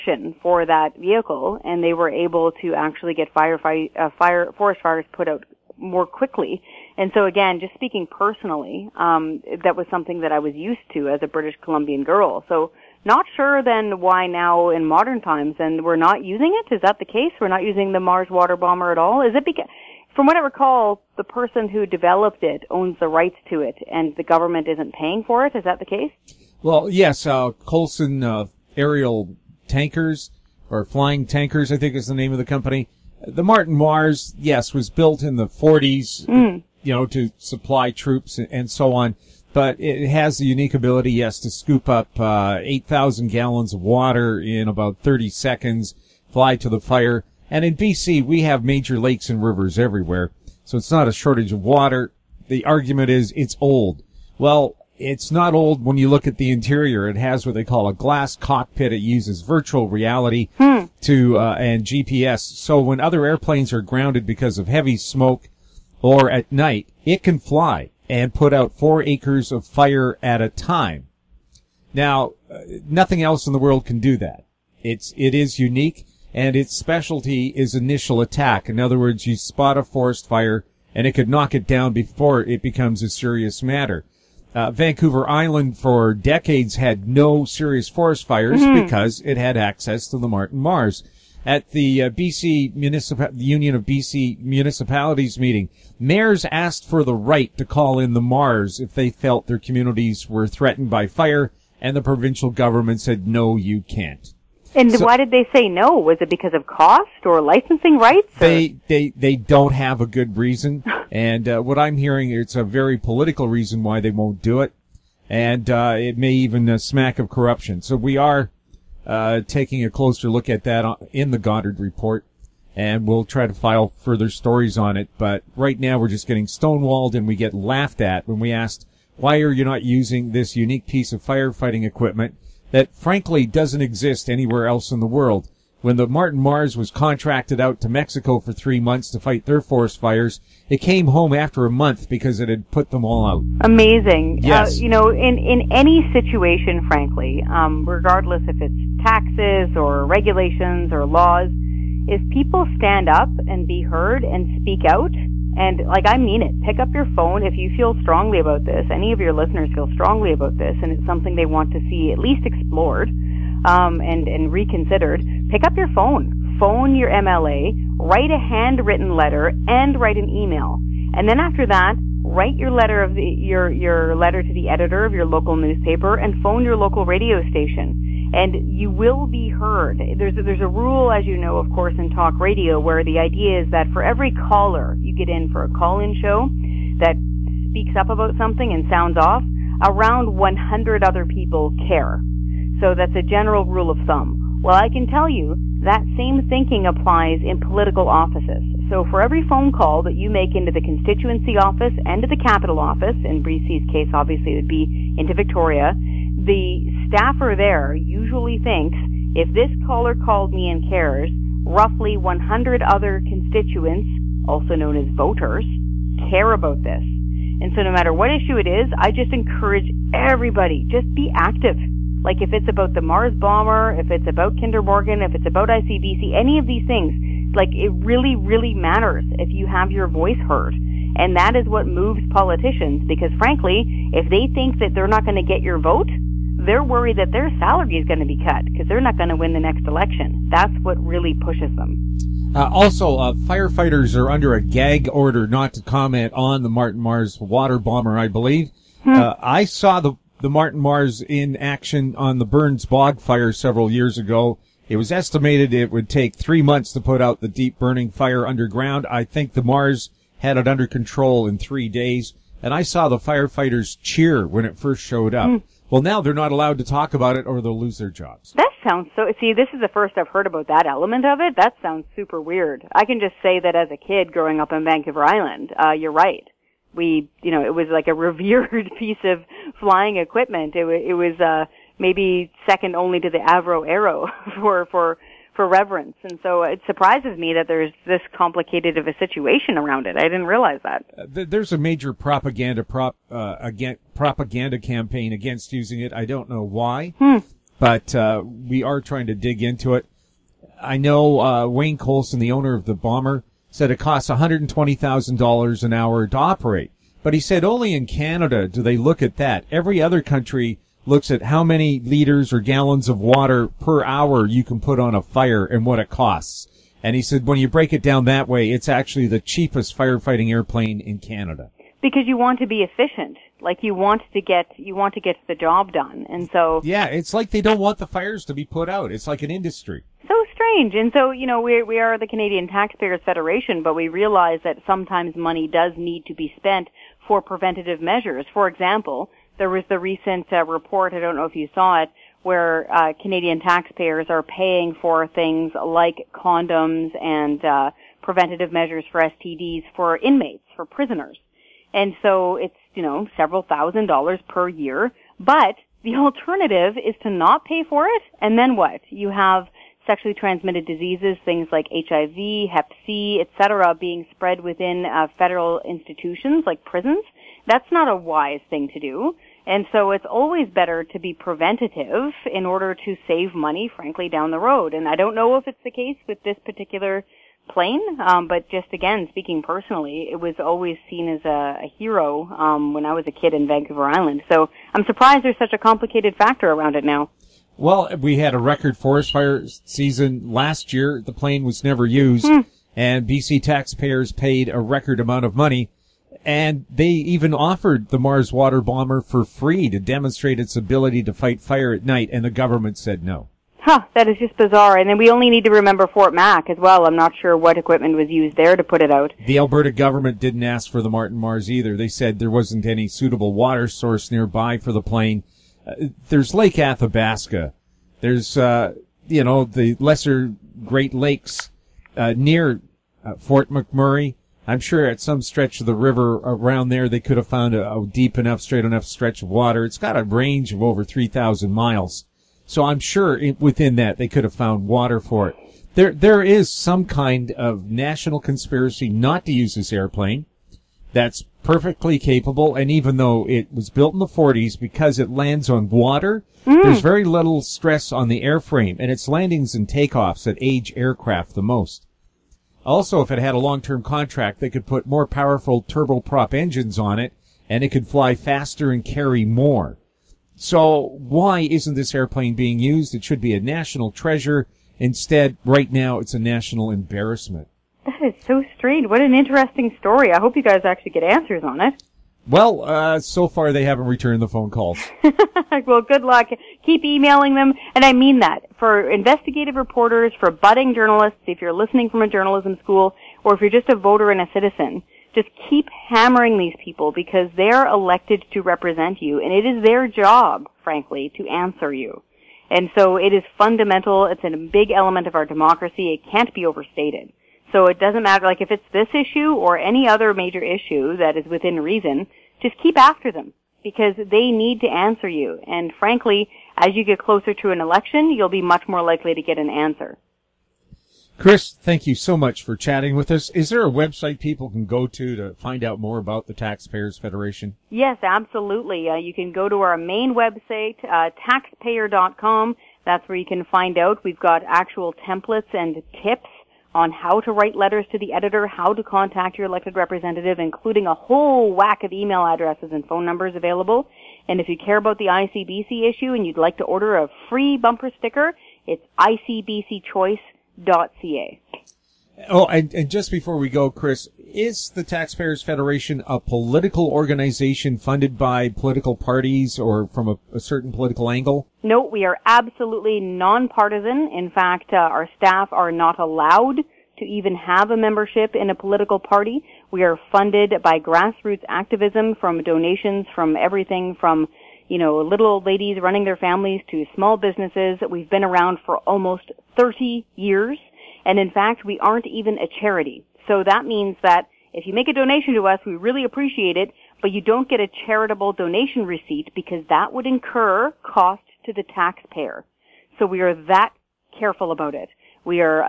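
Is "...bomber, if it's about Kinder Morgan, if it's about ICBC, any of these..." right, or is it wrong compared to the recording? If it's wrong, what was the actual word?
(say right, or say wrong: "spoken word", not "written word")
right.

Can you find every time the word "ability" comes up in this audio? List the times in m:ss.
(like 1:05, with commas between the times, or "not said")
0:40, 6:40.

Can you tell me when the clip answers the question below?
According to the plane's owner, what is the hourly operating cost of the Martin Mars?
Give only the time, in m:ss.
5:04.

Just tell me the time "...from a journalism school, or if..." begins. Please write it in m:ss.
8:02.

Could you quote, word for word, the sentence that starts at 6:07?
That's not a wise thing to do.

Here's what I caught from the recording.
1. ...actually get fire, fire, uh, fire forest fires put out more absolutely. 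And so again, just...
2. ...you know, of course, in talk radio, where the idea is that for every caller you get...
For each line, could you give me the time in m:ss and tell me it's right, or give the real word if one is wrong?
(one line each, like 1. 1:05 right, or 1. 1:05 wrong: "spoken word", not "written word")
1. 0:02 wrong: "quickly", not "absolutely"
2. 3:01 right.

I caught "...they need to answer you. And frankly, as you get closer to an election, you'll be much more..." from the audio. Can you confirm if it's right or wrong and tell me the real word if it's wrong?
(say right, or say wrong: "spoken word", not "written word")
right.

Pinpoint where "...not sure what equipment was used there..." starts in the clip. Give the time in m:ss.
6:47.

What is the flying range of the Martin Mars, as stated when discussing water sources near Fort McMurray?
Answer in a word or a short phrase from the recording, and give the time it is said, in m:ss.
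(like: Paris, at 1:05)
over 3,000 miles, at 7:10.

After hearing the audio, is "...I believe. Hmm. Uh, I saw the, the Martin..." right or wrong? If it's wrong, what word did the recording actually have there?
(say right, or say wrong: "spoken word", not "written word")
right.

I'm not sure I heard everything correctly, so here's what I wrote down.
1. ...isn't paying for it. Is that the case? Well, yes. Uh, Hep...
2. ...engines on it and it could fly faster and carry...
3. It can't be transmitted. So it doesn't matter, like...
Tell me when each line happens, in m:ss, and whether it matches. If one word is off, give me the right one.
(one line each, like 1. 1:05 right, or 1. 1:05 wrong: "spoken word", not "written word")
1. 0:24 wrong: "Coulson", not "Hep"
2. 7:36 right
3. 8:16 wrong: "overstated", not "transmitted".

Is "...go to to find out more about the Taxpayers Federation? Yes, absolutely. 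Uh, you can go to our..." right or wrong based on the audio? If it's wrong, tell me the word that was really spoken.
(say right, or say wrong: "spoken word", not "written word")
right.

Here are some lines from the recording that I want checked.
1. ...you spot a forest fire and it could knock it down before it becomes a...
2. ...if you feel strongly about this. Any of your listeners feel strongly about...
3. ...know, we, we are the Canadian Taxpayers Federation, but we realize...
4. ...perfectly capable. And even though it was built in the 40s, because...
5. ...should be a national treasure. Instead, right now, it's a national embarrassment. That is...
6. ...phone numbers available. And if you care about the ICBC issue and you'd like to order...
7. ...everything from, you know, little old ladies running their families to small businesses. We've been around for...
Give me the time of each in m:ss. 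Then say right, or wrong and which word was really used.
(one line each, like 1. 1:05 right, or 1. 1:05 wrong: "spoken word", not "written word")
1. 1:19 right
2. 2:37 right
3. 5:31 right
4. 7:21 right
5. 7:43 right
6. 8:53 right
7. 9:23 right.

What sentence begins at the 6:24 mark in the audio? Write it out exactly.
So I'm surprised there's such a complicated factor around it now.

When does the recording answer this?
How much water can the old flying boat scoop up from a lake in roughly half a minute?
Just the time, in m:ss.
0:42.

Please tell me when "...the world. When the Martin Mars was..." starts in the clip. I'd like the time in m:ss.
2:14.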